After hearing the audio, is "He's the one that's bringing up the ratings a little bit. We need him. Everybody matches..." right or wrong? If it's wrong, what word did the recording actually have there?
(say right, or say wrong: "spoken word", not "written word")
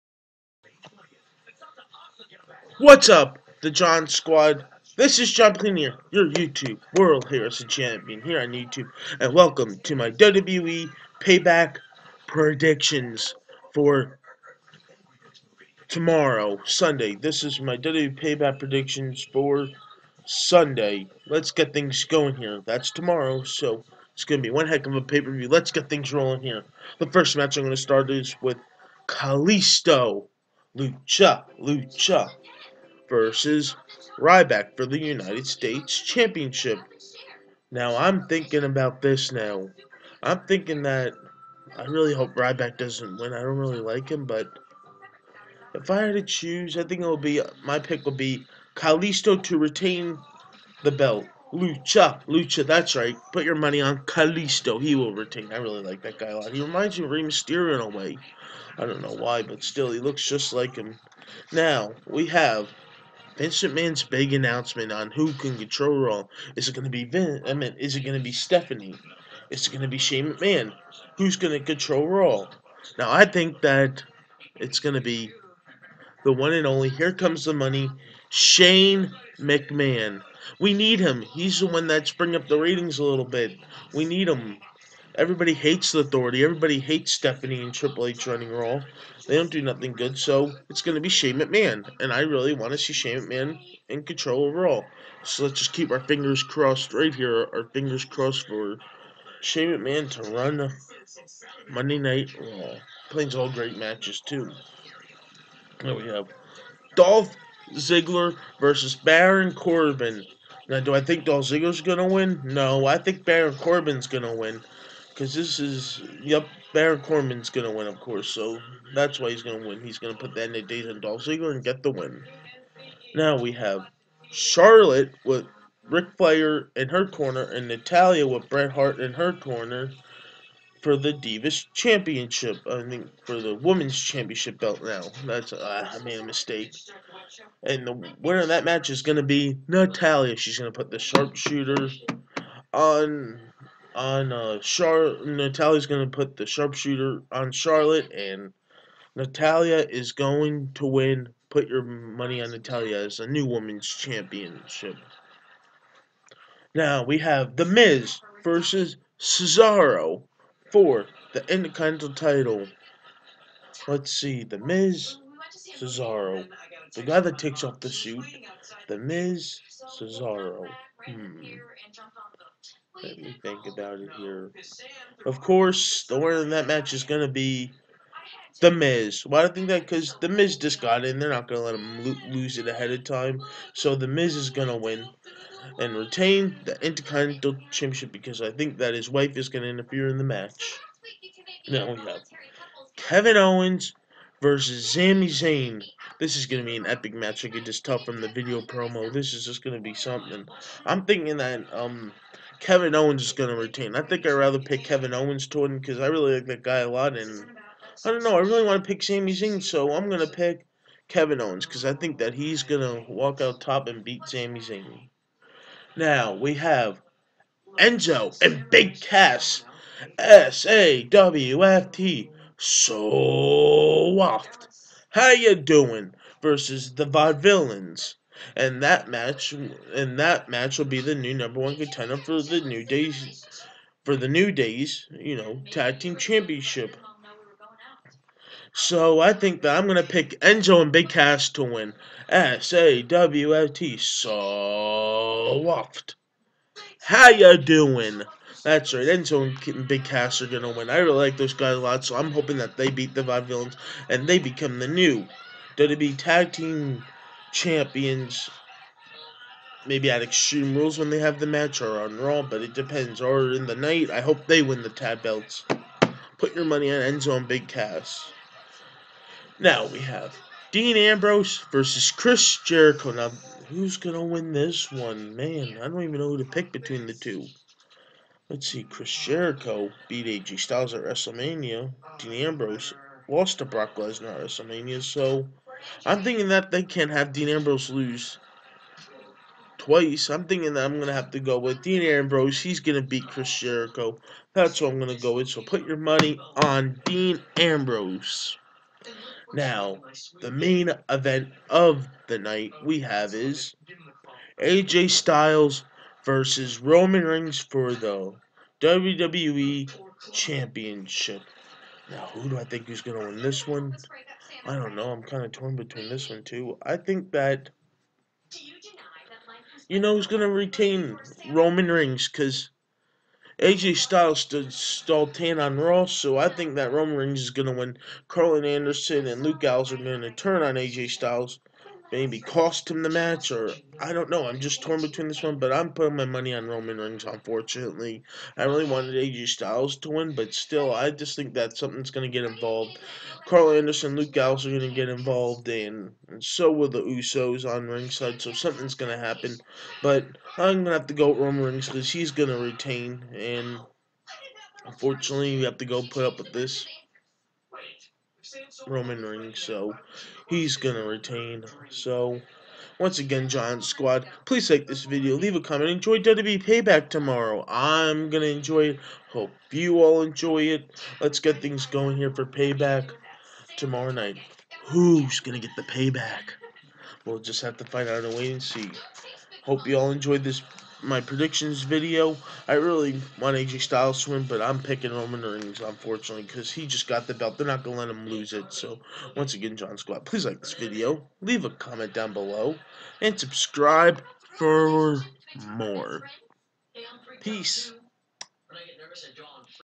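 wrong: "hates", not "matches".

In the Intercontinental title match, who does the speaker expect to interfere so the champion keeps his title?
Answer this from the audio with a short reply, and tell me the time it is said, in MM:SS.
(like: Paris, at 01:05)
his wife, at 03:08.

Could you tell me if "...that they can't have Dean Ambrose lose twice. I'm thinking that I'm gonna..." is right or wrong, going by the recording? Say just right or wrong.
right.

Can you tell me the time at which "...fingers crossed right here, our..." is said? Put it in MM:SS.
01:35.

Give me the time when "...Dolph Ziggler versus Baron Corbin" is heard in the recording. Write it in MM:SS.
01:46.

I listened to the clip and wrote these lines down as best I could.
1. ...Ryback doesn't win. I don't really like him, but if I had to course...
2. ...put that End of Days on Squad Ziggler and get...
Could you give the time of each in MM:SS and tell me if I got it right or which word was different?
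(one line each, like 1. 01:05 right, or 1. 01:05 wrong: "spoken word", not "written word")
1. 00:42 wrong: "choose", not "course"
2. 02:00 wrong: "Dolph", not "Squad".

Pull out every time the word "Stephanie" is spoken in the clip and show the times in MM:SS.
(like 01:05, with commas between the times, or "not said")
01:08, 01:27.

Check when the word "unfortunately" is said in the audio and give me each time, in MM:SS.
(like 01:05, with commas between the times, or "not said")
05:37, 05:54, 06:25.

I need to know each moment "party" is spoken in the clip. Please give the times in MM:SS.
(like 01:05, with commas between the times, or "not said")
not said.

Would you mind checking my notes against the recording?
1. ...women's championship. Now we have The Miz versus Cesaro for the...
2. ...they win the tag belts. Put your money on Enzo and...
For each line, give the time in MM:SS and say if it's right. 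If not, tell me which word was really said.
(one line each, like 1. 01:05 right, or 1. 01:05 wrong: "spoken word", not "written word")
1. 02:33 right
2. 04:24 right.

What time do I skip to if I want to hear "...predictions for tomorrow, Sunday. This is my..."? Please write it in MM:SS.
00:12.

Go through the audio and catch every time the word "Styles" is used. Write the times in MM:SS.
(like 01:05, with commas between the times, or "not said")
04:40, 05:05, 05:23, 05:31, 05:39, 06:23.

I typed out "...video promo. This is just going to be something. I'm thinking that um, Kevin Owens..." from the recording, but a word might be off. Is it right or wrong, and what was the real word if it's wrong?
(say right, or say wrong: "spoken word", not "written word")
right.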